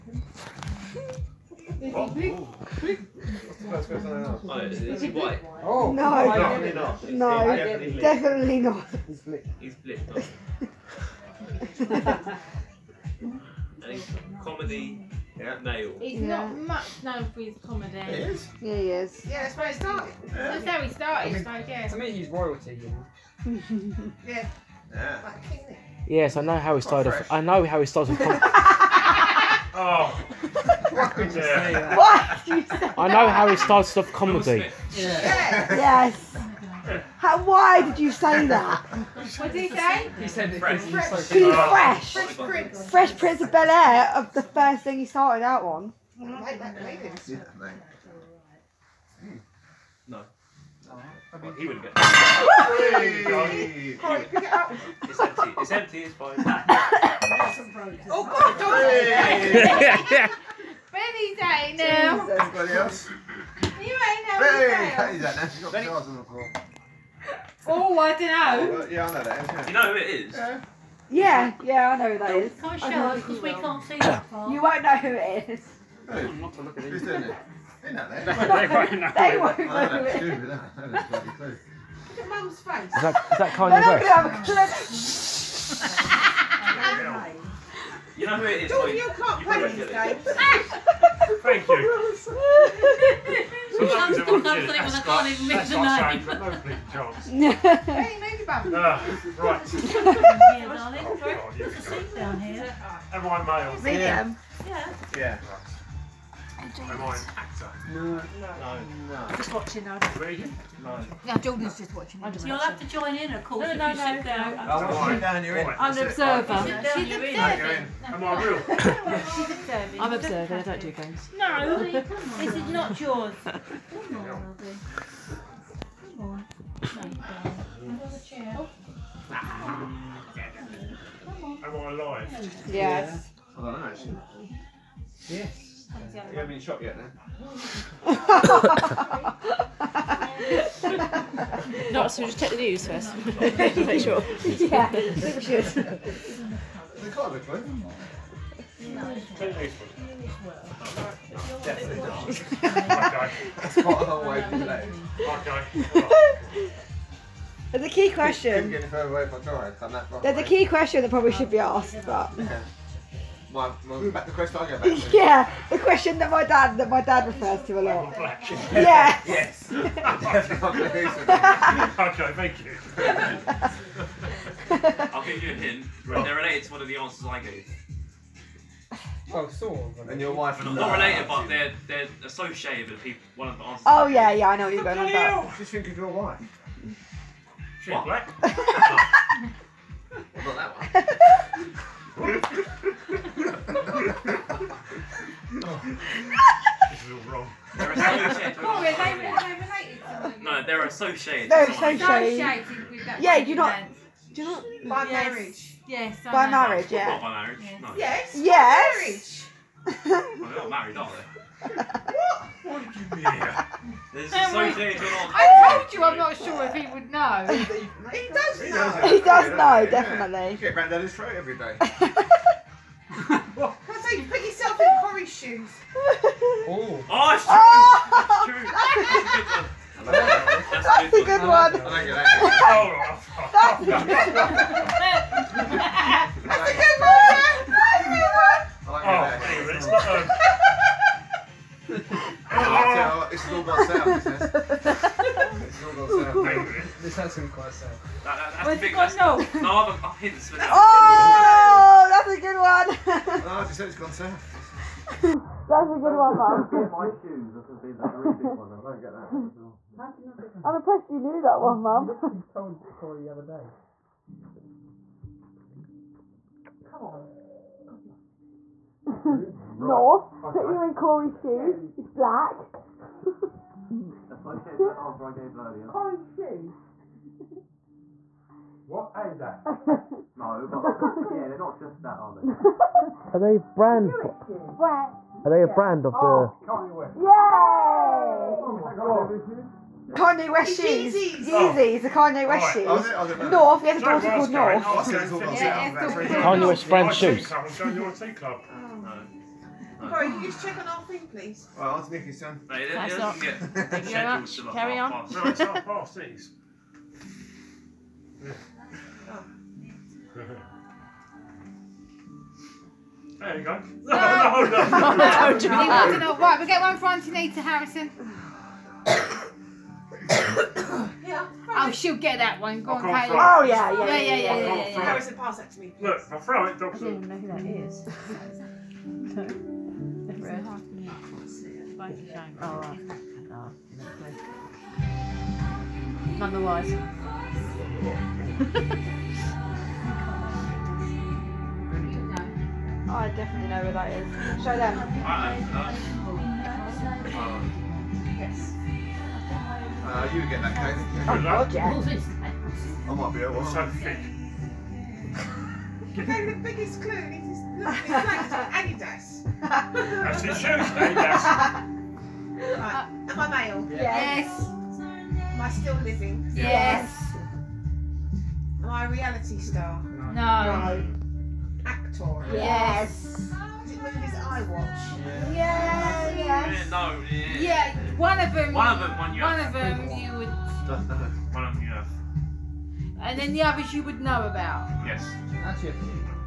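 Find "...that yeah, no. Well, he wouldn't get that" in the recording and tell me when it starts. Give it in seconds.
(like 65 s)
46 s.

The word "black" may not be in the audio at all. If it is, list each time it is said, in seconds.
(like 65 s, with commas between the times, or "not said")
188 s, 272 s.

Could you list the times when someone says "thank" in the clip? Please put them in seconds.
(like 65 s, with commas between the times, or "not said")
91 s, 172 s.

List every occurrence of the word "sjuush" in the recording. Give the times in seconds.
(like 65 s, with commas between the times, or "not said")
not said.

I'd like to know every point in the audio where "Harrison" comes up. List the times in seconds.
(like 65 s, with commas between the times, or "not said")
317 s, 325 s.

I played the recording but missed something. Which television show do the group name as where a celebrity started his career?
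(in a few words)
Fresh Prince of Bel Air.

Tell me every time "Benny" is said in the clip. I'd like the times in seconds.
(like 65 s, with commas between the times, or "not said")
60 s, 64 s.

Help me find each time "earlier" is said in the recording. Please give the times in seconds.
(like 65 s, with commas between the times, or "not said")
275 s.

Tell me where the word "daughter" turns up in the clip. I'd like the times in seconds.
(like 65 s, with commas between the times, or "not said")
294 s.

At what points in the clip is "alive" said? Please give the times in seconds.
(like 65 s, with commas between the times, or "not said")
131 s.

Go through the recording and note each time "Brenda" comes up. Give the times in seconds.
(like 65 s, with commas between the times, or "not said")
not said.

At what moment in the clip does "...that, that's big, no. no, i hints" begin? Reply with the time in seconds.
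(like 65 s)
248 s.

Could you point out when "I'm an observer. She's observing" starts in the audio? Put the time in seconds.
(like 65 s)
115 s.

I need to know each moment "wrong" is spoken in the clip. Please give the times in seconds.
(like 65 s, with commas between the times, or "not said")
197 s.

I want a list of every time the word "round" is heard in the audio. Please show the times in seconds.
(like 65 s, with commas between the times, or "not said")
220 s.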